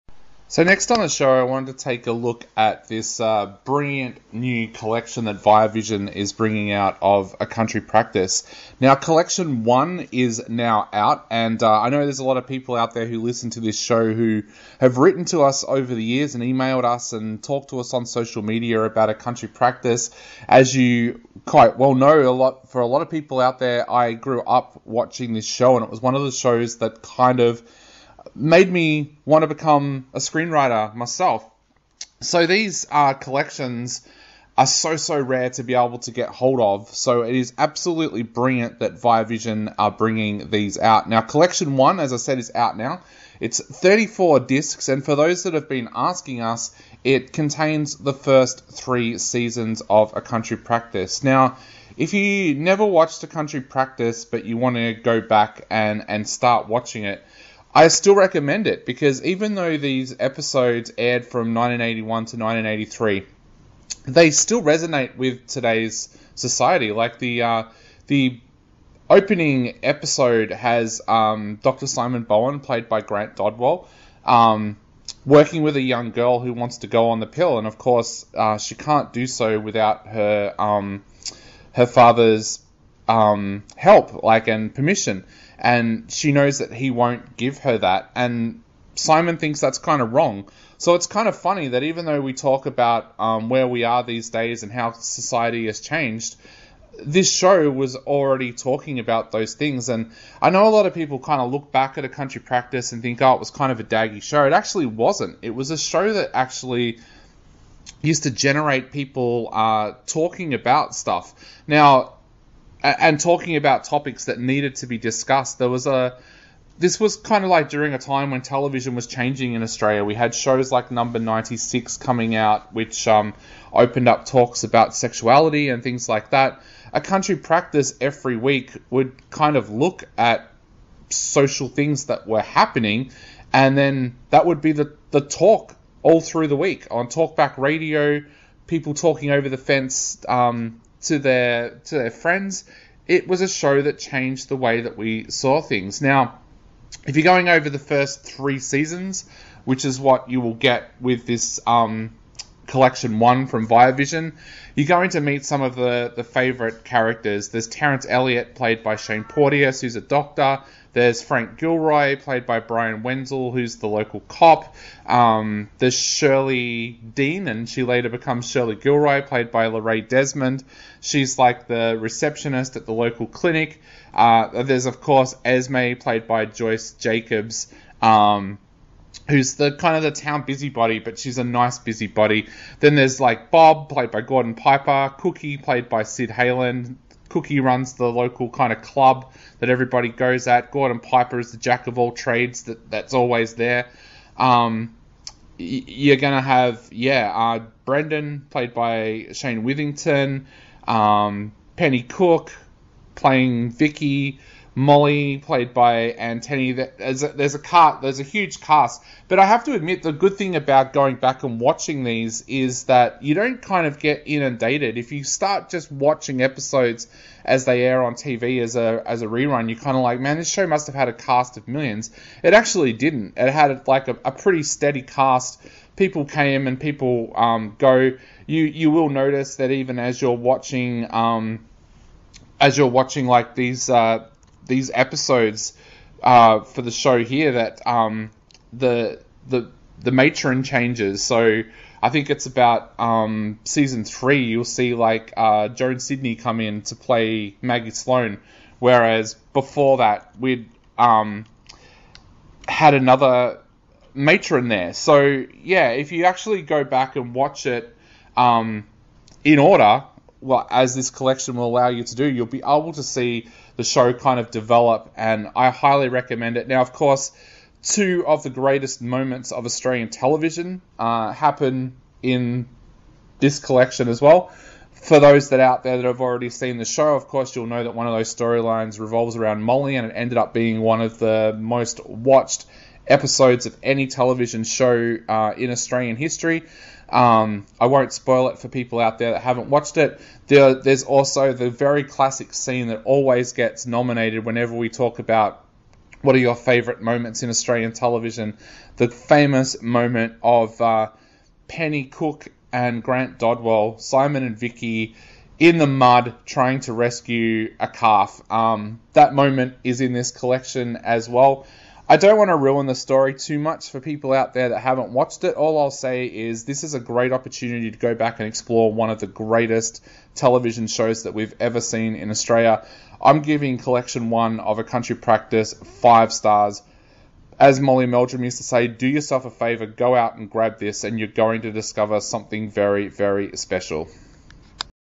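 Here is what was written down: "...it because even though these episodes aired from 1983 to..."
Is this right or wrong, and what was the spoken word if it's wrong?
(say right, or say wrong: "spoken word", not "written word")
wrong: "1981", not "1983".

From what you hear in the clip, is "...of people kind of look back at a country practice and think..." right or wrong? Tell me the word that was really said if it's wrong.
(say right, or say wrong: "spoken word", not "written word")
right.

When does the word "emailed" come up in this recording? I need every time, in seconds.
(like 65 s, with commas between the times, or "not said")
16 s.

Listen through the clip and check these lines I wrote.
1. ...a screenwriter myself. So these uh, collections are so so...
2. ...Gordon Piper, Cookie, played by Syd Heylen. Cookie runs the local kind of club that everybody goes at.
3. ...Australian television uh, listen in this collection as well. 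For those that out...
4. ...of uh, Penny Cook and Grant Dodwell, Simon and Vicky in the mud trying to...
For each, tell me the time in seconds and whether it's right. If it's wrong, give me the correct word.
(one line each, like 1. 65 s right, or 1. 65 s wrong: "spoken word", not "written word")
1. 30 s right
2. 184 s right
3. 269 s wrong: "happen", not "listen"
4. 300 s right.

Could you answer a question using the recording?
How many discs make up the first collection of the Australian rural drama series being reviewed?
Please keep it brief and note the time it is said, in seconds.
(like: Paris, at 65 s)
34, at 43 s.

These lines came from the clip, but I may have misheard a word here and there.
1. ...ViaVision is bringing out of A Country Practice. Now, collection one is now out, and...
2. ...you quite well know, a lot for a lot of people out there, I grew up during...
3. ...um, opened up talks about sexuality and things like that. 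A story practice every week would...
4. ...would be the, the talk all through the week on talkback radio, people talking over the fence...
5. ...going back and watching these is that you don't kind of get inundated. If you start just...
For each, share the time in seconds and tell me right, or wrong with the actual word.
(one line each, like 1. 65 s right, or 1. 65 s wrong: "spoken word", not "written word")
1. 5 s right
2. 20 s wrong: "watching", not "during"
3. 123 s wrong: "country", not "story"
4. 134 s right
5. 210 s right.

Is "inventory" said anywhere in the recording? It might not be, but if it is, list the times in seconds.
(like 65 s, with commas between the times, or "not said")
not said.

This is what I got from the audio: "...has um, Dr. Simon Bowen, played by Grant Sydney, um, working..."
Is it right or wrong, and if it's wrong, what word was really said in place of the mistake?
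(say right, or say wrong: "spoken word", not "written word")
wrong: "Dodwell", not "Sydney".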